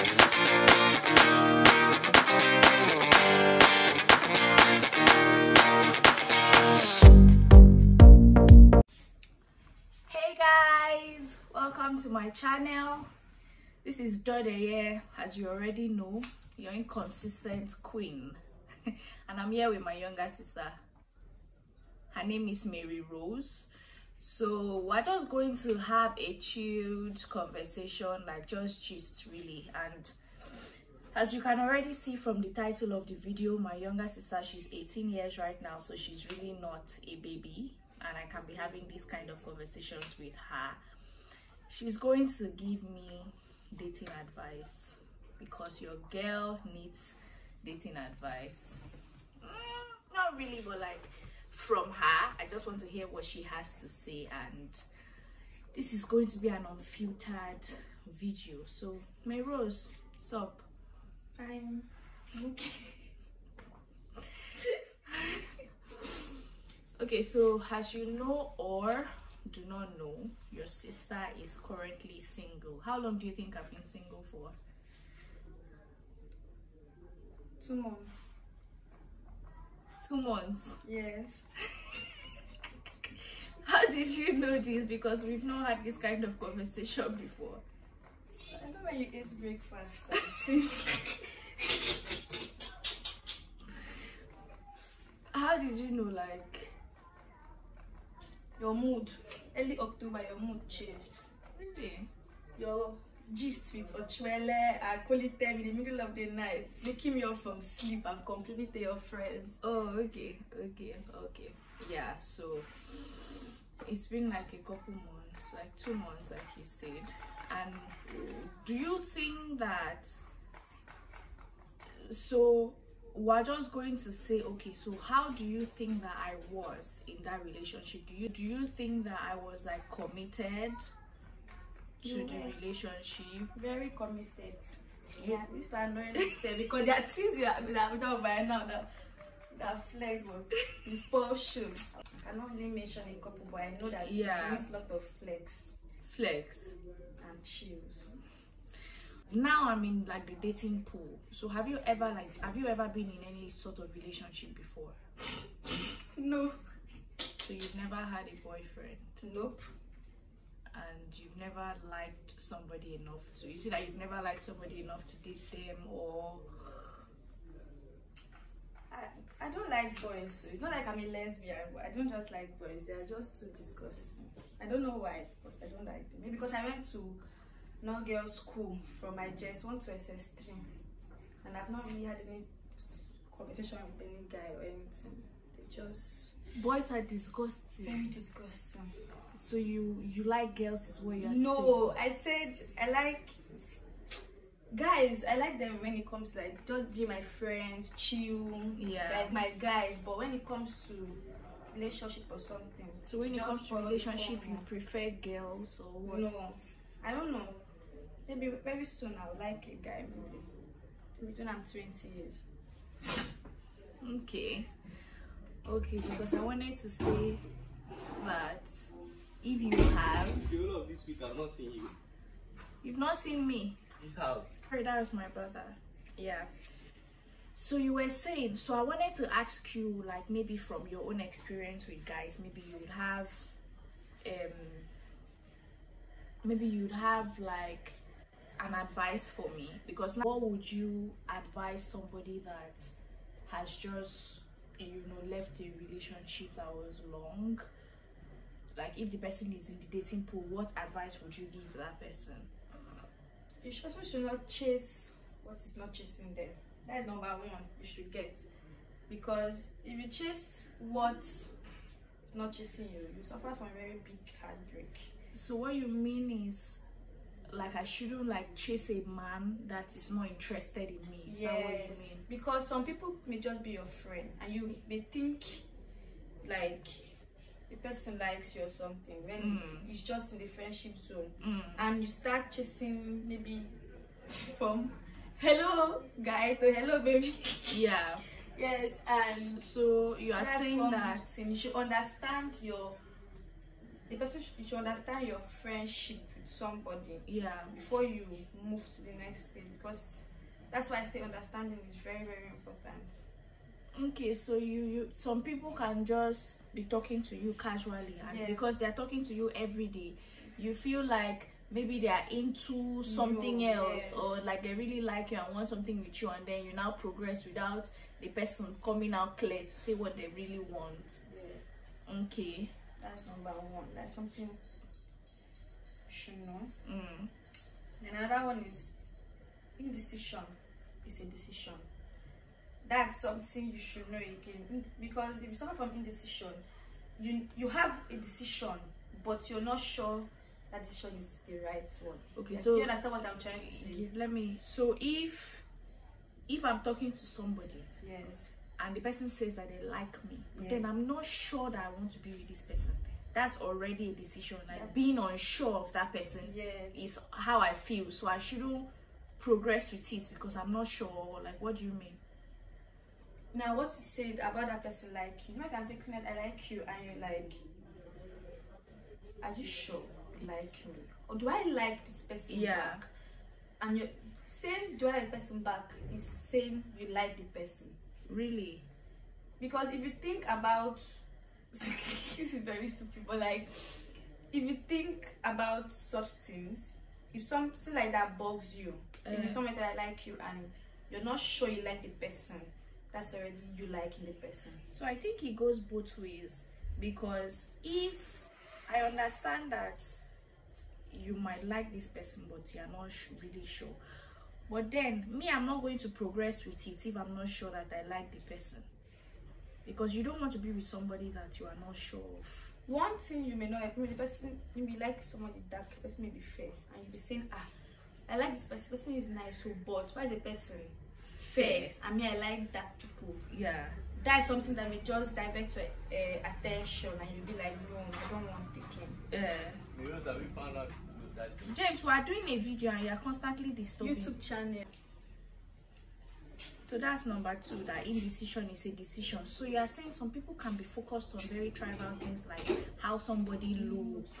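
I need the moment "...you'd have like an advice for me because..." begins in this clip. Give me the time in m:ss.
3:56.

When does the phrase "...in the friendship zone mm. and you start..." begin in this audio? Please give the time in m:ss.
4:40.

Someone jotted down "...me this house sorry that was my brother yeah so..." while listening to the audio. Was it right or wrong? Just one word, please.
right.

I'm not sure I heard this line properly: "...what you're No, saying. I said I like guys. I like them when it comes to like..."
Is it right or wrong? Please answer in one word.
right.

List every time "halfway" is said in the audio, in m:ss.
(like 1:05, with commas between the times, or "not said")
not said.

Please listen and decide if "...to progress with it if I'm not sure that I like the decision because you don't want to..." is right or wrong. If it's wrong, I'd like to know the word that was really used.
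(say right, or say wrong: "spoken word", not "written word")
wrong: "person", not "decision".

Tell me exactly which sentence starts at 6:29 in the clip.
if someone that like you and you're not sure you like the person, that's already you liking the person.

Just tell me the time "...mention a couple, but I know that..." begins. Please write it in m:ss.
2:22.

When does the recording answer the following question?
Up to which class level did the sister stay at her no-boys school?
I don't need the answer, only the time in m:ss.
2:59.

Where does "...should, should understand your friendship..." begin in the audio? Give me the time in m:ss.
4:54.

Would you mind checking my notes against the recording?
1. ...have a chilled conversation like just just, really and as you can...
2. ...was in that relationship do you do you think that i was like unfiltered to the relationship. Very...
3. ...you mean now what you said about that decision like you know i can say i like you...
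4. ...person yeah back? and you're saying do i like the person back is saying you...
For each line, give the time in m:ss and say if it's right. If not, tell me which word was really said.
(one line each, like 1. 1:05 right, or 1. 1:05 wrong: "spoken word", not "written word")
1. 0:25 right
2. 2:06 wrong: "committed", not "unfiltered"
3. 6:01 wrong: "person", not "decision"
4. 6:12 right.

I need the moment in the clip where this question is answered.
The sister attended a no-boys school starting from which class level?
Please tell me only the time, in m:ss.
2:59.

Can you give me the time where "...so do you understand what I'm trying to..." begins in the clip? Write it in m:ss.
5:42.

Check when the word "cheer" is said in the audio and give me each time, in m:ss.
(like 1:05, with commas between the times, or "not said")
not said.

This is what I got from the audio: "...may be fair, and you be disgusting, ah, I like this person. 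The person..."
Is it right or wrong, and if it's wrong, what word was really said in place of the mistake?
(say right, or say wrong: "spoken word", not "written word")
wrong: "saying", not "disgusting".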